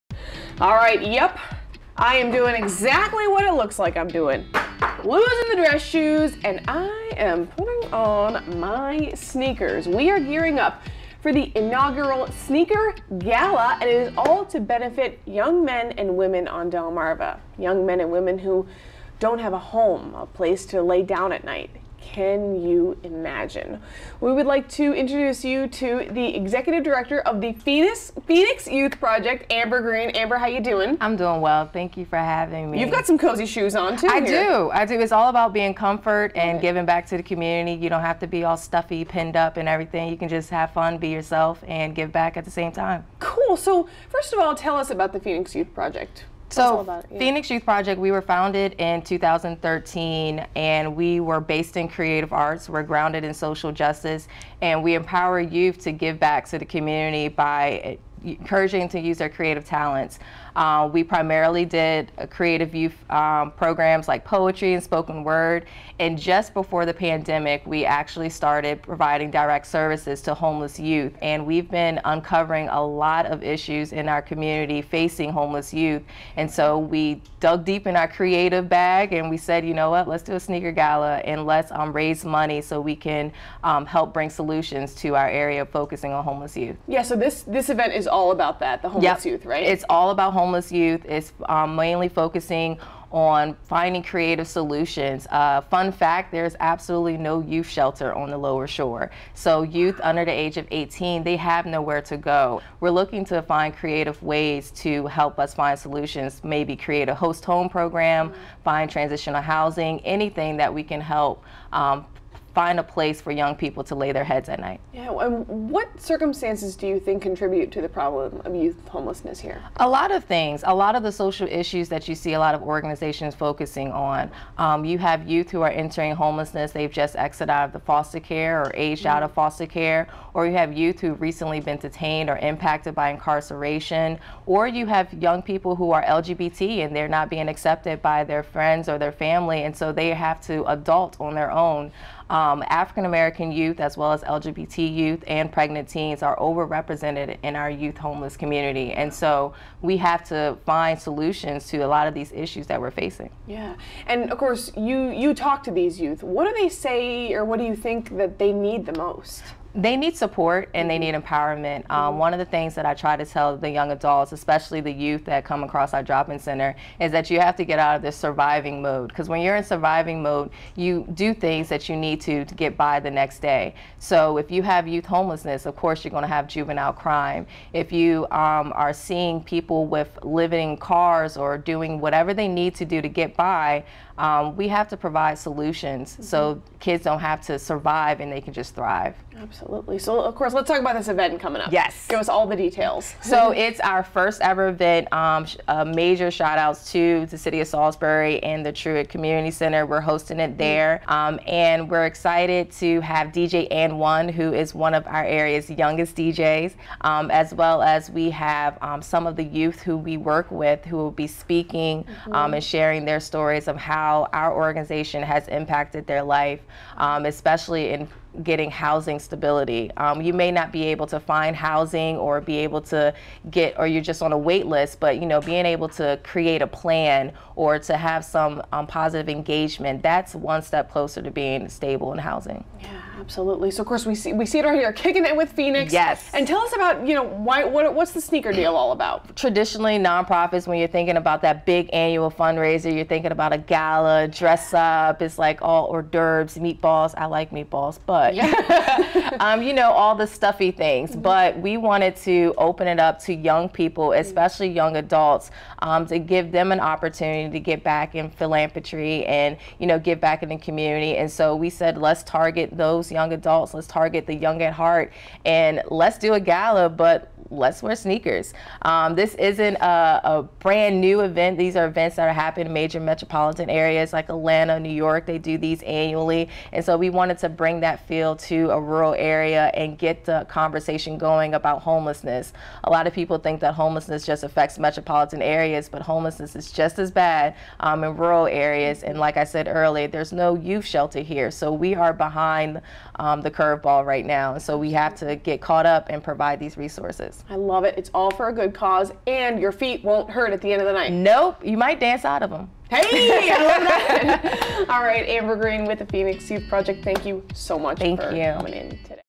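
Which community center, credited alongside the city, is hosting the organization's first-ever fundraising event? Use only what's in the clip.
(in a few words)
Truitt Community Center.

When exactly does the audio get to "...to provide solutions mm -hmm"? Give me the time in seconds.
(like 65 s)
184 s.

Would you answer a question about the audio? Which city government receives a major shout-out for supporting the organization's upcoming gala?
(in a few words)
Salisbury.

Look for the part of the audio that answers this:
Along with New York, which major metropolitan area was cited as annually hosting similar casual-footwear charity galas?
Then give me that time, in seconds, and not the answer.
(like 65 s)
274 s.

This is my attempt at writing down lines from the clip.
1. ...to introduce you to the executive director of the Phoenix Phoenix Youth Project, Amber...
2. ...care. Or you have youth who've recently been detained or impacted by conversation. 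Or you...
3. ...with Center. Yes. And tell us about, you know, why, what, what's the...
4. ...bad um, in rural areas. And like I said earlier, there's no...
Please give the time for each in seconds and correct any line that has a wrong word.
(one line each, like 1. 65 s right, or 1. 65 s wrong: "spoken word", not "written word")
1. 24 s right
2. 129 s wrong: "incarceration", not "conversation"
3. 235 s wrong: "Phoenix", not "Center"
4. 287 s right.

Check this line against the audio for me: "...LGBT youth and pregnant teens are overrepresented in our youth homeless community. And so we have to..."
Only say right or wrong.
right.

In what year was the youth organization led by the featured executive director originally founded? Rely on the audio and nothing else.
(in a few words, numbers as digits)
2013.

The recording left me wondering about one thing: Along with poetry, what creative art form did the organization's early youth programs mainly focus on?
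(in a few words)
Spoken word.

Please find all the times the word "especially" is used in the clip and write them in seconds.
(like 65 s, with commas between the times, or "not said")
164 s, 217 s, 254 s.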